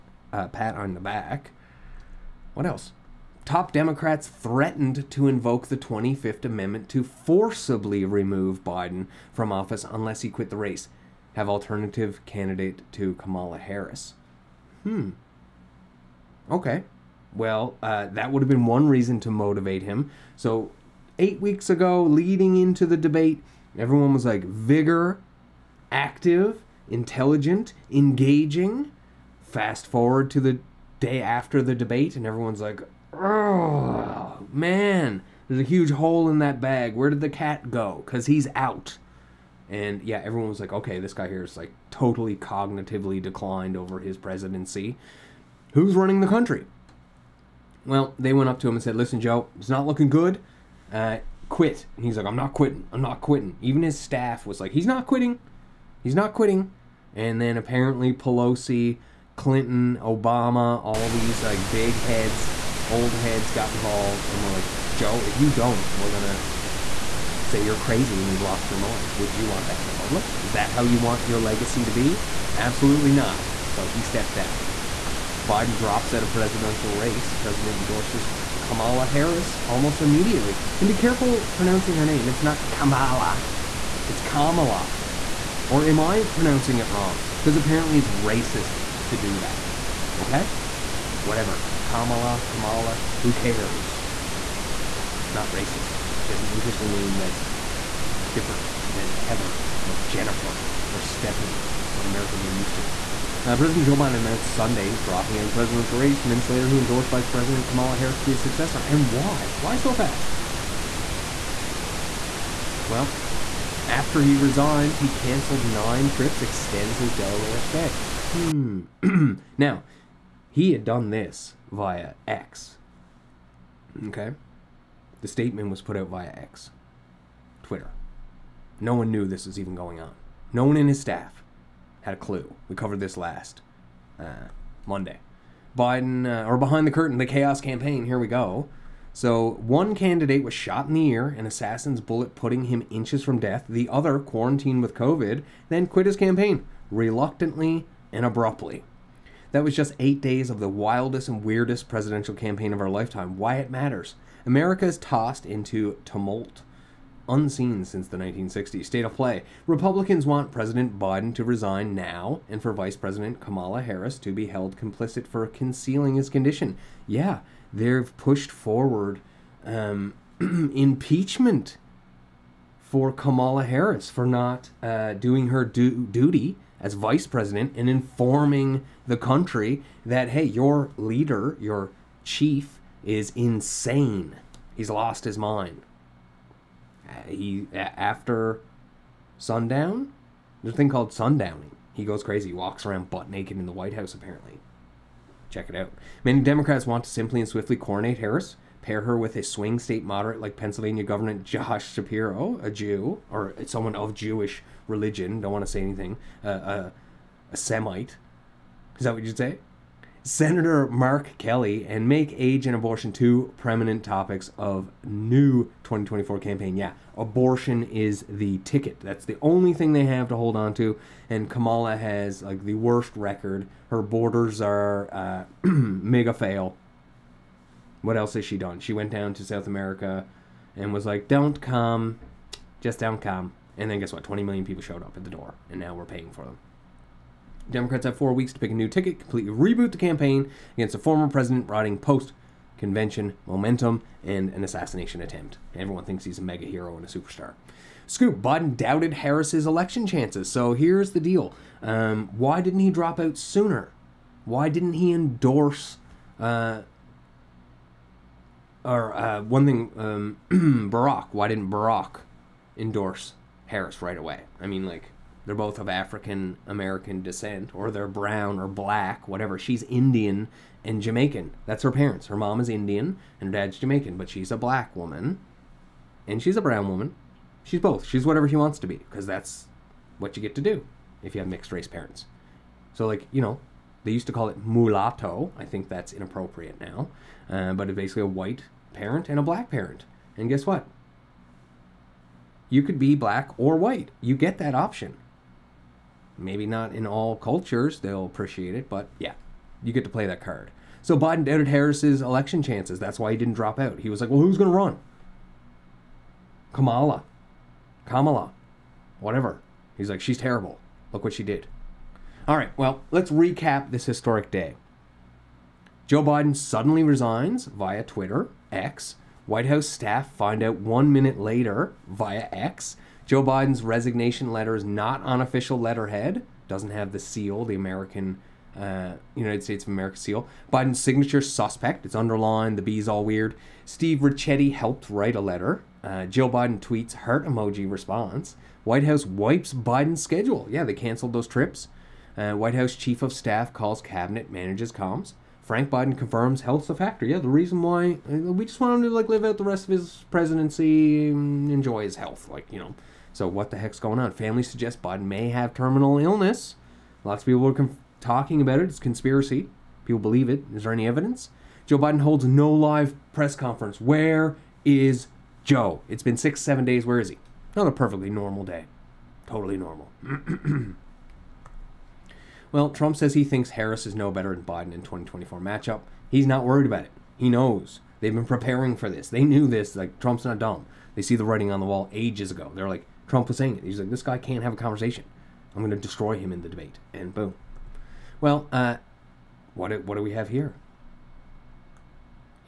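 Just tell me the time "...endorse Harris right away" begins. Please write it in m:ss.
4:22.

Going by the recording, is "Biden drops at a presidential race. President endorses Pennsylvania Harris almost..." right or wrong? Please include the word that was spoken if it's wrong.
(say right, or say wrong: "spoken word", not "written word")
wrong: "Kamala", not "Pennsylvania".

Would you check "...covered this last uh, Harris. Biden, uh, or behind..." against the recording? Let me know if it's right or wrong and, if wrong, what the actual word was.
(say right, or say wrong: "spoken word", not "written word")
wrong: "Monday", not "Harris".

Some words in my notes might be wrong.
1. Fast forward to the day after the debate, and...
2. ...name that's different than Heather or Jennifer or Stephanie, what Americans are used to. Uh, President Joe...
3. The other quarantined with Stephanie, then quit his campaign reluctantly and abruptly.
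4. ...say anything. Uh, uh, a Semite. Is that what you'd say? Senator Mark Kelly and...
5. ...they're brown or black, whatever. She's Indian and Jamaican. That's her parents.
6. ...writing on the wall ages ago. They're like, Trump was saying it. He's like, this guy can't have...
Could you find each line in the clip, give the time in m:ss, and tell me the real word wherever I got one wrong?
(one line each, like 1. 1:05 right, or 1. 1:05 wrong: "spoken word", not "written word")
1. 0:29 right
2. 1:36 right
3. 2:23 wrong: "COVID", not "Stephanie"
4. 3:25 right
5. 4:27 right
6. 6:21 right.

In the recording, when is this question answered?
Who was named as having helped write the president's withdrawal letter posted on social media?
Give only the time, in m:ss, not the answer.
5:33.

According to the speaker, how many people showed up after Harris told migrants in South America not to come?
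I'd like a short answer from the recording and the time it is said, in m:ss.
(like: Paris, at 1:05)
20 million, at 3:54.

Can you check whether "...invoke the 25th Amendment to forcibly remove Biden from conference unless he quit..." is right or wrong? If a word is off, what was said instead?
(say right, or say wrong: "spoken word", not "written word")
wrong: "office", not "conference".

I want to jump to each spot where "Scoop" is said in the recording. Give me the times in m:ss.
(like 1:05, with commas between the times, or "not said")
4:08.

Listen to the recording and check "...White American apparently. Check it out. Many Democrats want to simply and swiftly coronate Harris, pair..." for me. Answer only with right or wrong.
wrong.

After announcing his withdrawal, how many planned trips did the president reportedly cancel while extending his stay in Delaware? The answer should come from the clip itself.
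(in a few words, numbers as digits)
9.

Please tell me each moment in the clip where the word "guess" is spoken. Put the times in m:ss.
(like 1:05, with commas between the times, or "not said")
3:53, 4:50.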